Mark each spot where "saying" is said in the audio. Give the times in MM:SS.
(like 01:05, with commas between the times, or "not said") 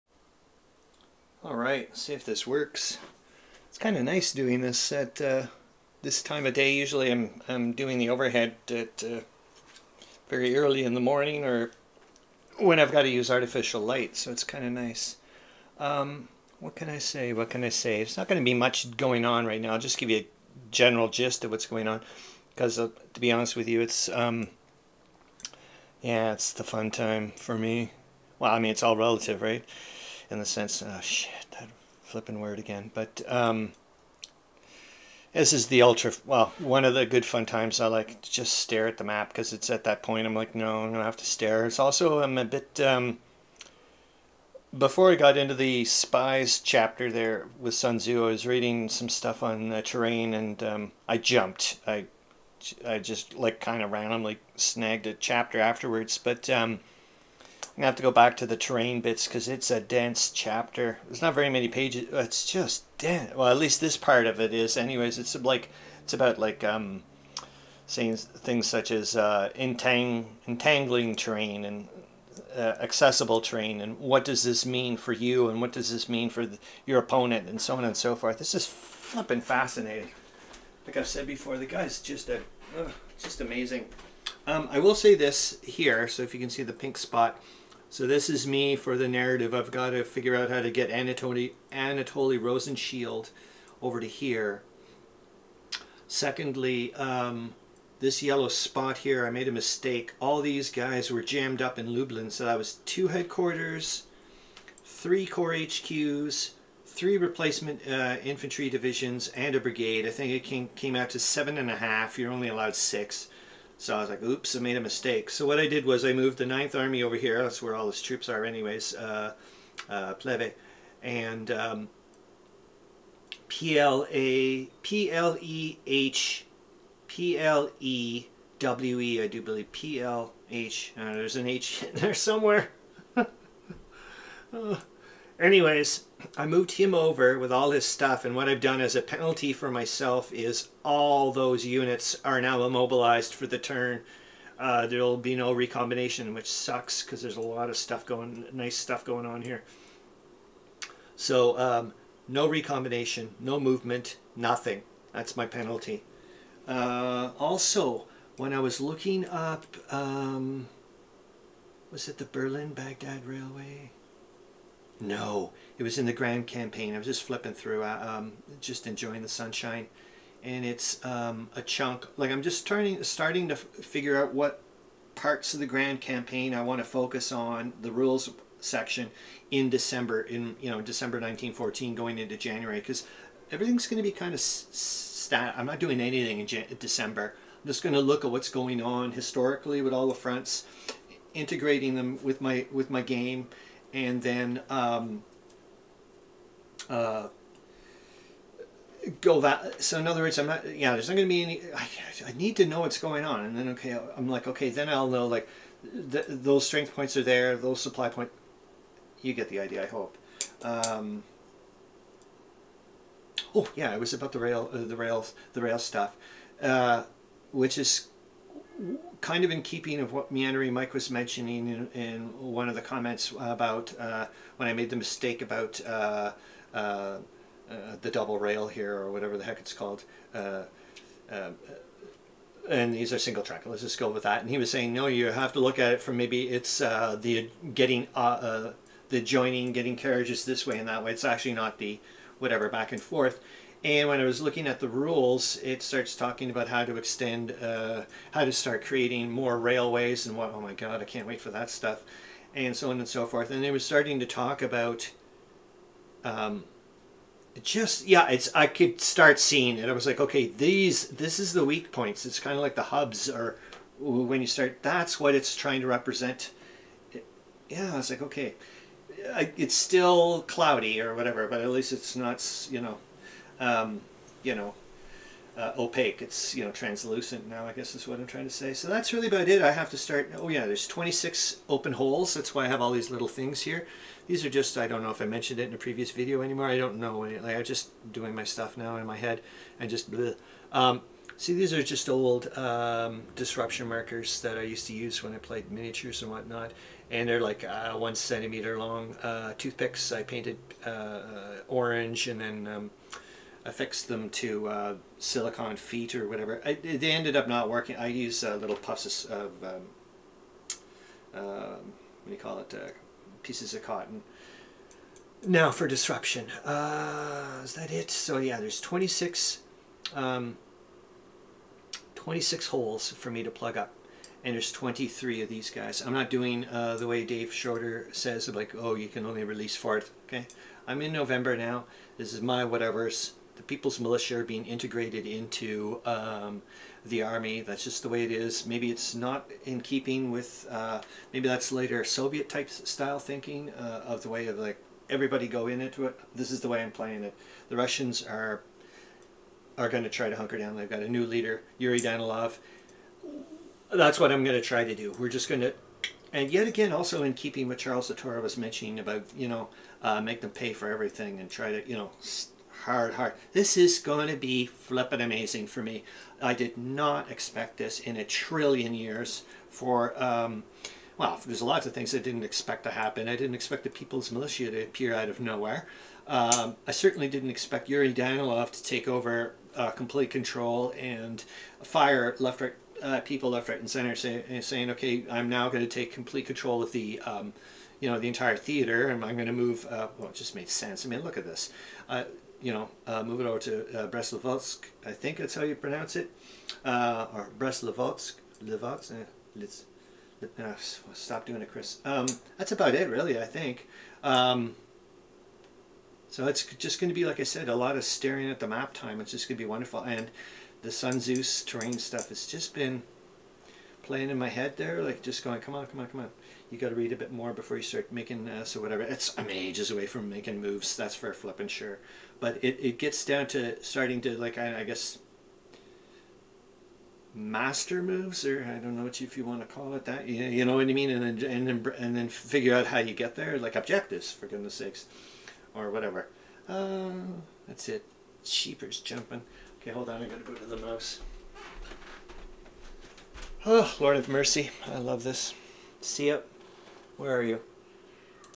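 01:07, 03:54, 06:24.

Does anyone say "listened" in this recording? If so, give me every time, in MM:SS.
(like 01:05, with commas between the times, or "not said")
not said.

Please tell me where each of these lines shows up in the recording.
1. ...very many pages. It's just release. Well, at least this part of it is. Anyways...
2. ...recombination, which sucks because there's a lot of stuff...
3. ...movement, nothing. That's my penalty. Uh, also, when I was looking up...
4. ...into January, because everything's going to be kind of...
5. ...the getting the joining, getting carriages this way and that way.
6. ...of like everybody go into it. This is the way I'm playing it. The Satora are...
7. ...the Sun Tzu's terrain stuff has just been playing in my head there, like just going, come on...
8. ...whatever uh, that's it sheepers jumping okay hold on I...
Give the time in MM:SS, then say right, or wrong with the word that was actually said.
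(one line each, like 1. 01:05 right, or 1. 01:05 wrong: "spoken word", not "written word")
1. 01:01 wrong: "dense", not "release"
2. 02:25 right
3. 02:33 right
4. 03:02 right
5. 03:56 right
6. 05:44 wrong: "Russians", not "Satora"
7. 06:50 right
8. 07:15 right.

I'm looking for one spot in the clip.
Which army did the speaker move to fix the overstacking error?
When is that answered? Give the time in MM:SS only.
01:56.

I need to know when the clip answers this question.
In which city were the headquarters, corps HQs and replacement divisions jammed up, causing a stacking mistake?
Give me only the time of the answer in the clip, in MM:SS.
01:41.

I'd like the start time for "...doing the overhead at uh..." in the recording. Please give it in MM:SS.
00:07.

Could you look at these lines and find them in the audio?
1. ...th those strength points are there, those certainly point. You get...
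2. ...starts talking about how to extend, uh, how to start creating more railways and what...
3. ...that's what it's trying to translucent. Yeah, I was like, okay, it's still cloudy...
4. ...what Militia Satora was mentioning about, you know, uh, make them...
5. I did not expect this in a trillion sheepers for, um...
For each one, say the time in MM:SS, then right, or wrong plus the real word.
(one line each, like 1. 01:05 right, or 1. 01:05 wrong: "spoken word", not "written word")
1. 03:26 wrong: "supply", not "certainly"
2. 04:05 right
3. 04:24 wrong: "represent", not "translucent"
4. 05:57 wrong: "Charles", not "Militia"
5. 06:06 wrong: "years", not "sheepers".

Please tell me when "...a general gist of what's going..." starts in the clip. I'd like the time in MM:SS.
00:20.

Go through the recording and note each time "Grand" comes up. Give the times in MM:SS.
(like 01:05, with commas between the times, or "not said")
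02:46, 02:55.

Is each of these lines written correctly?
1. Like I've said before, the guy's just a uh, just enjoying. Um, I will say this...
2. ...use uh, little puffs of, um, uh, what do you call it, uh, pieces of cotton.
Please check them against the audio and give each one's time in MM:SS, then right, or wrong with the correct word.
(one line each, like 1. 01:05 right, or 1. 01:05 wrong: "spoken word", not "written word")
1. 01:20 wrong: "amazing", not "enjoying"
2. 05:08 right.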